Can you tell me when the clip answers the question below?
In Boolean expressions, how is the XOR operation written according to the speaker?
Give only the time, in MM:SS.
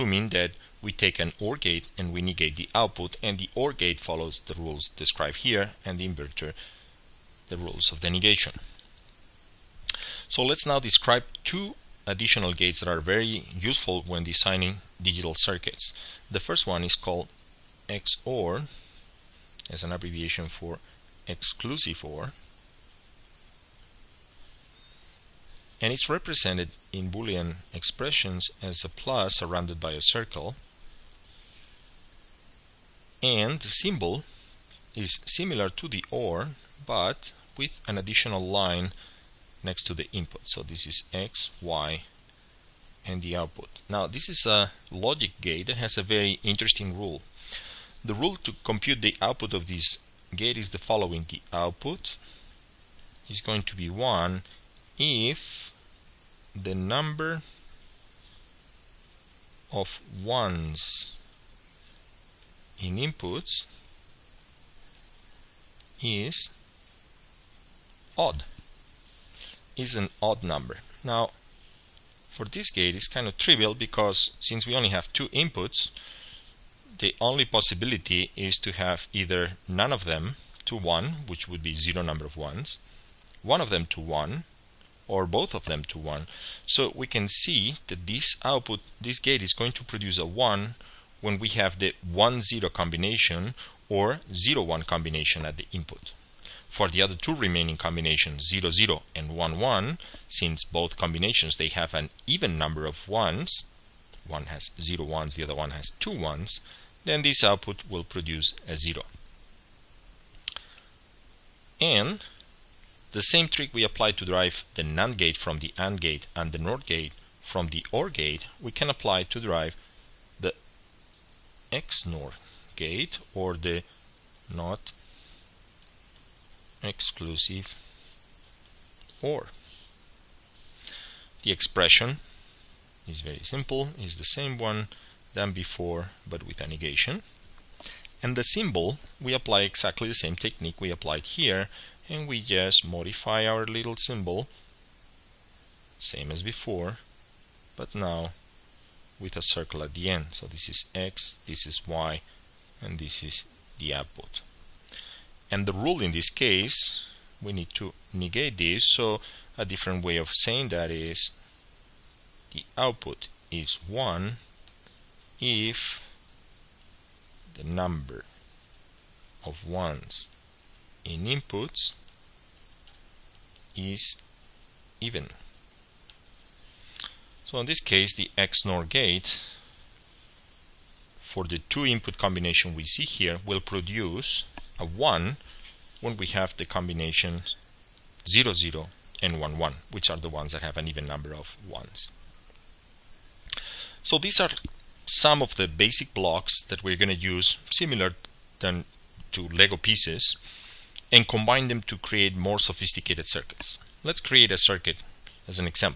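00:28.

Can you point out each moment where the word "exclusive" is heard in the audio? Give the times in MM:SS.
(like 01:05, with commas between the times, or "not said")
00:21, 02:06.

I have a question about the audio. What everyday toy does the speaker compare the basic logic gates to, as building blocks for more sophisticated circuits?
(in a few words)
Lego pieces.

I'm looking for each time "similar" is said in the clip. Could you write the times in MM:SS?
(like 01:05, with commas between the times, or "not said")
00:35, 03:17.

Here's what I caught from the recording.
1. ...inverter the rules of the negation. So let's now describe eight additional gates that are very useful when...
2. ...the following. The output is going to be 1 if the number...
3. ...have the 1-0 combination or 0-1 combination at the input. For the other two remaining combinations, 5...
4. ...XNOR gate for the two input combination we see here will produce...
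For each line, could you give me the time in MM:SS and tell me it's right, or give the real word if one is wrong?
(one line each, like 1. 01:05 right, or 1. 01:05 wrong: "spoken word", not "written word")
1. 00:06 wrong: "two", not "eight"
2. 00:50 right
3. 01:31 wrong: "0", not "5"
4. 02:58 right.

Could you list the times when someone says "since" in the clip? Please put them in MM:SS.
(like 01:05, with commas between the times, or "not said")
01:14, 01:40.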